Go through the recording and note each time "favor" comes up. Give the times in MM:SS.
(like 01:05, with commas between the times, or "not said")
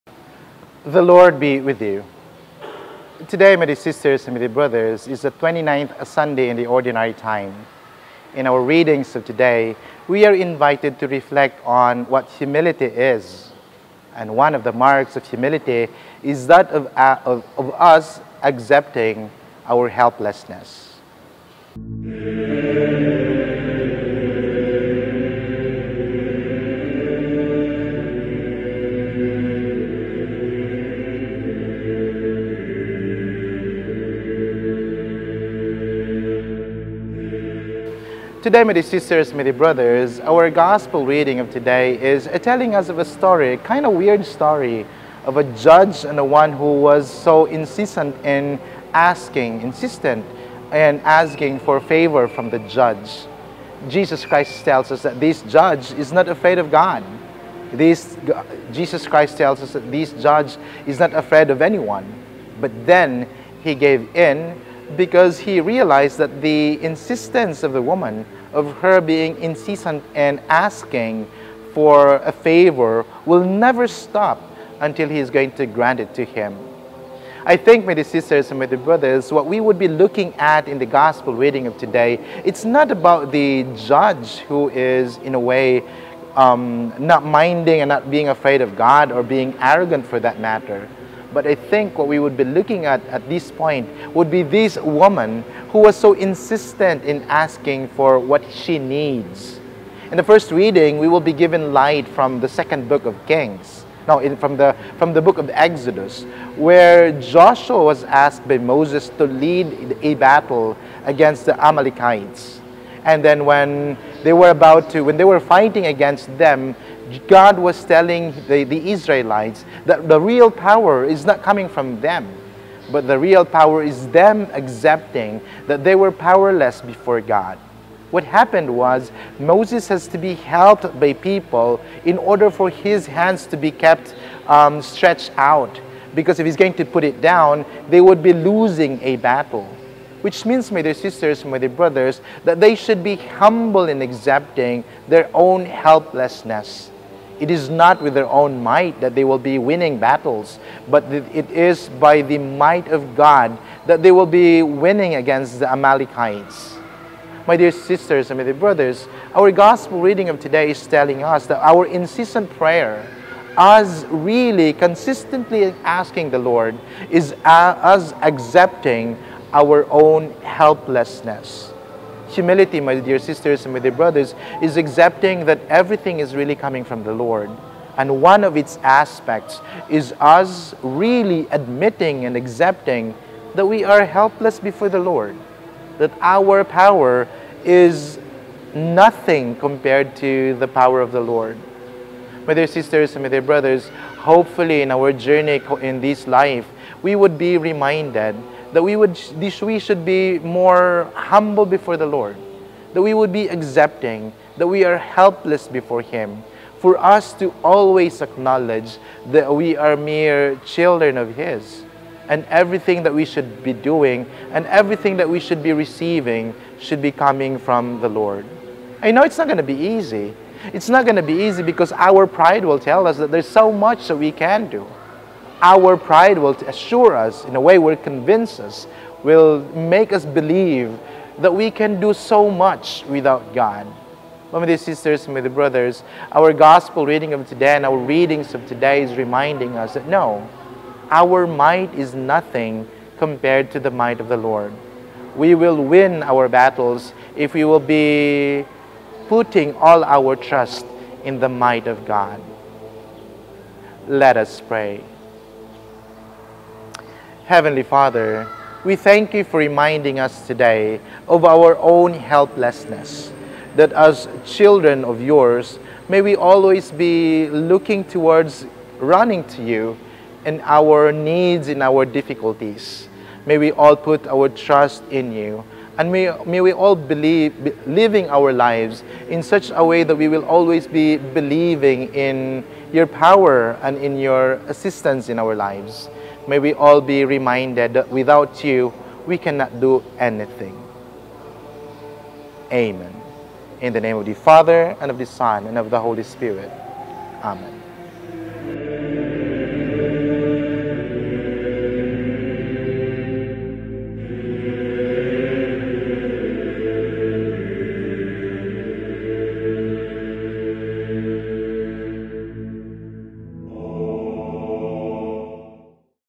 00:51, 01:12.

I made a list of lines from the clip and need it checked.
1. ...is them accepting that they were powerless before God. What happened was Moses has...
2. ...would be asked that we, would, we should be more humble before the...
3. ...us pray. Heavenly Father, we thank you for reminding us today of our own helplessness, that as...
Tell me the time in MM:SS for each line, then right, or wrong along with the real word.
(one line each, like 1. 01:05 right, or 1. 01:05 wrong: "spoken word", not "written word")
1. 02:03 right
2. 03:17 wrong: "reminded", not "asked"
3. 04:14 right.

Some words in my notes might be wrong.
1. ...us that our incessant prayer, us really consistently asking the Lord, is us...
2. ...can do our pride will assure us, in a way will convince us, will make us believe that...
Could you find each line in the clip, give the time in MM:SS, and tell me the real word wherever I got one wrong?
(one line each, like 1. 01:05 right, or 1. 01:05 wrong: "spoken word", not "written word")
1. 02:41 right
2. 03:44 right.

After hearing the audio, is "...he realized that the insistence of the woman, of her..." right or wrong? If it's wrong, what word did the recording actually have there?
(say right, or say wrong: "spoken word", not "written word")
right.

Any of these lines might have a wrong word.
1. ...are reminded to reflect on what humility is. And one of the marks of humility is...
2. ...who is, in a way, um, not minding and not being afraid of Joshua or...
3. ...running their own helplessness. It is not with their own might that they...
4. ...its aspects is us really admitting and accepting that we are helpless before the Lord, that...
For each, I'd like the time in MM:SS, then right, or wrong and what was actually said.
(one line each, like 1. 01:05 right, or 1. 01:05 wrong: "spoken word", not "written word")
1. 00:10 wrong: "invited", not "reminded"
2. 01:24 wrong: "God", not "Joshua"
3. 02:24 wrong: "accepting", not "running"
4. 02:58 right.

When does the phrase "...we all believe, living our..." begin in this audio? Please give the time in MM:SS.
04:36.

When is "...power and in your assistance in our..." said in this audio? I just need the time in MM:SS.
04:43.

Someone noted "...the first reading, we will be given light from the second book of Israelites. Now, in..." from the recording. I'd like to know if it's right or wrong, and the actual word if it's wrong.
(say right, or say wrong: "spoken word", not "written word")
wrong: "Kings", not "Israelites".